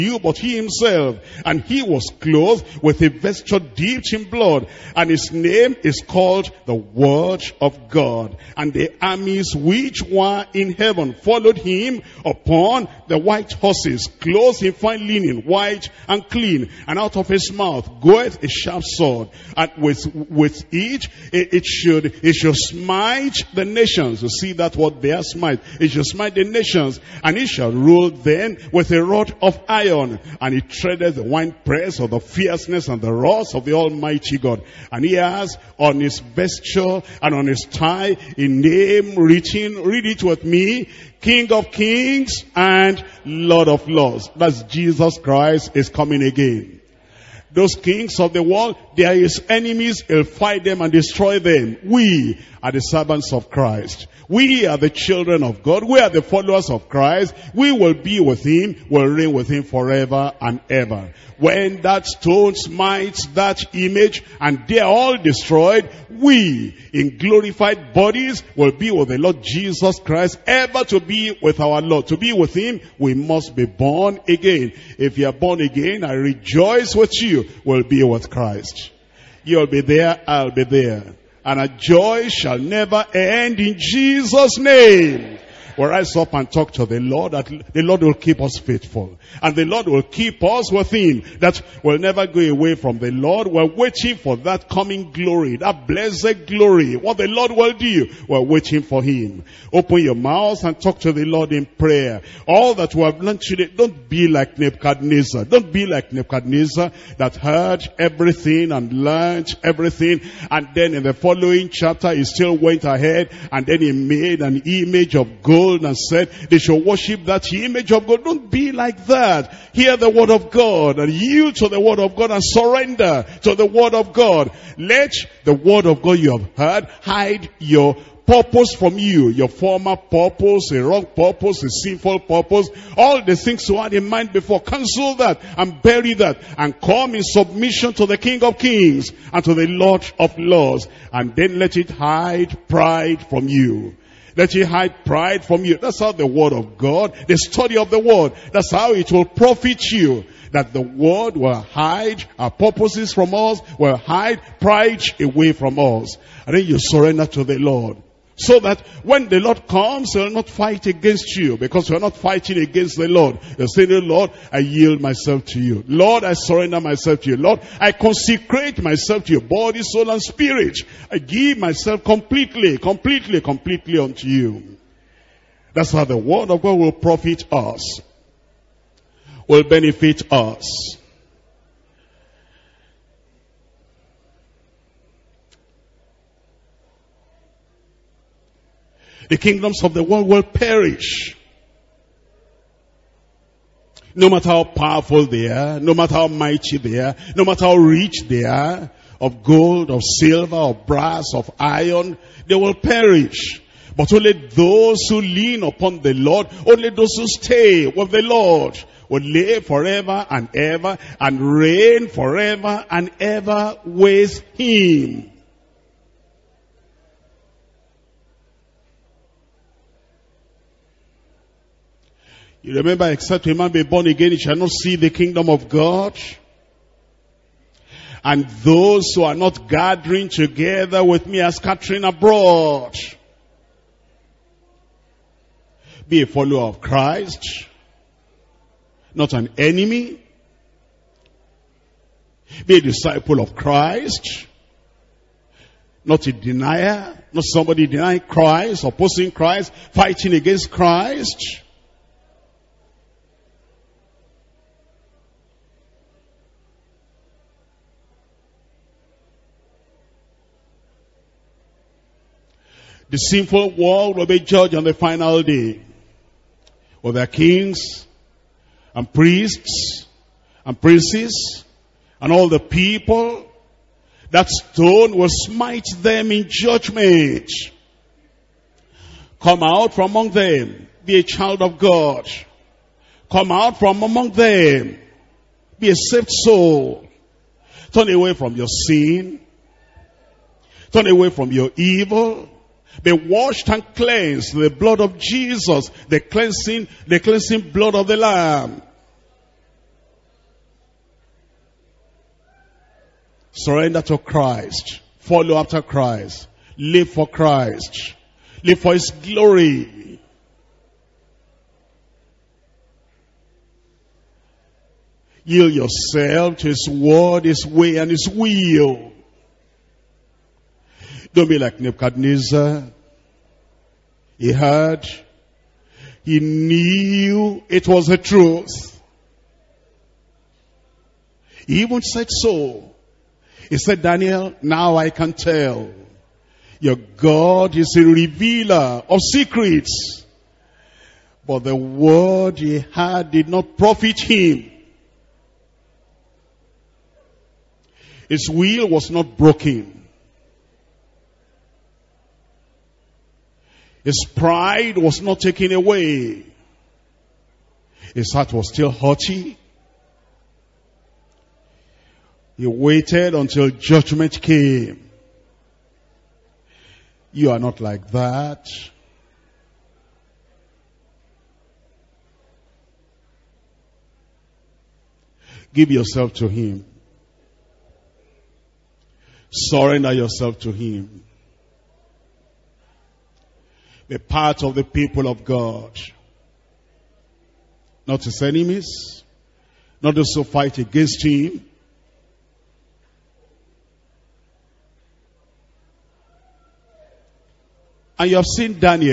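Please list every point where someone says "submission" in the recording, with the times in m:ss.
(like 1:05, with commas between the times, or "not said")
2:17.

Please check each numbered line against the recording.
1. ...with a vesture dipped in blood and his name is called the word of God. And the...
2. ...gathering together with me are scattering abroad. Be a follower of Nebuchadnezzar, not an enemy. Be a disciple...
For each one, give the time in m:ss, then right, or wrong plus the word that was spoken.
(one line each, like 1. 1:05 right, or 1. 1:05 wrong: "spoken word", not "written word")
1. 0:02 right
2. 3:49 wrong: "Christ", not "Nebuchadnezzar".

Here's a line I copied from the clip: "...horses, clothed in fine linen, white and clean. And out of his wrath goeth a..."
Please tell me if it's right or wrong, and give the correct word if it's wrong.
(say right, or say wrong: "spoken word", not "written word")
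wrong: "mouth", not "wrath".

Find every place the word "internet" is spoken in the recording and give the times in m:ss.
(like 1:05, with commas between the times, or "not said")
not said.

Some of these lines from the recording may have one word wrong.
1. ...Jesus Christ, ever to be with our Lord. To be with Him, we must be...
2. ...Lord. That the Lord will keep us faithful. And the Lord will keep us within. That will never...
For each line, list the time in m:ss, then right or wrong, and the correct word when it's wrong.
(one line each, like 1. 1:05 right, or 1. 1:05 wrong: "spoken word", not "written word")
1. 1:09 right
2. 1:26 right.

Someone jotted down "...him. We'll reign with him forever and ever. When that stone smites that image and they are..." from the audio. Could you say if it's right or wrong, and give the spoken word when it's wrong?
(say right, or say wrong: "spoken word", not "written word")
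right.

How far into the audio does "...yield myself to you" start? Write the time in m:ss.
2:44.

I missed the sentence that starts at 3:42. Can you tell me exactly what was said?
You remember, except a man be born again, he shall not see the kingdom of God.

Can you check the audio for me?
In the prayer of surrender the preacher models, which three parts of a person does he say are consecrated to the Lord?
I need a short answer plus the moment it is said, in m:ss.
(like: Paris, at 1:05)
body, soul, and spirit, at 2:49.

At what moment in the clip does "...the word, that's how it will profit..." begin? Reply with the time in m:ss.
2:27.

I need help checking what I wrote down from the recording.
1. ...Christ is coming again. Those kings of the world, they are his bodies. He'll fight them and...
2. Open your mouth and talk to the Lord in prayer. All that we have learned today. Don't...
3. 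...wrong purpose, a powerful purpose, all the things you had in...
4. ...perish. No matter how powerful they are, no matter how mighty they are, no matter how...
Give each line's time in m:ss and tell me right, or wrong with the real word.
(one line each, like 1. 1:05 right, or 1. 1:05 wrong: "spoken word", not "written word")
1. 0:45 wrong: "enemies", not "bodies"
2. 1:39 right
3. 2:10 wrong: "sinful", not "powerful"
4. 3:10 right.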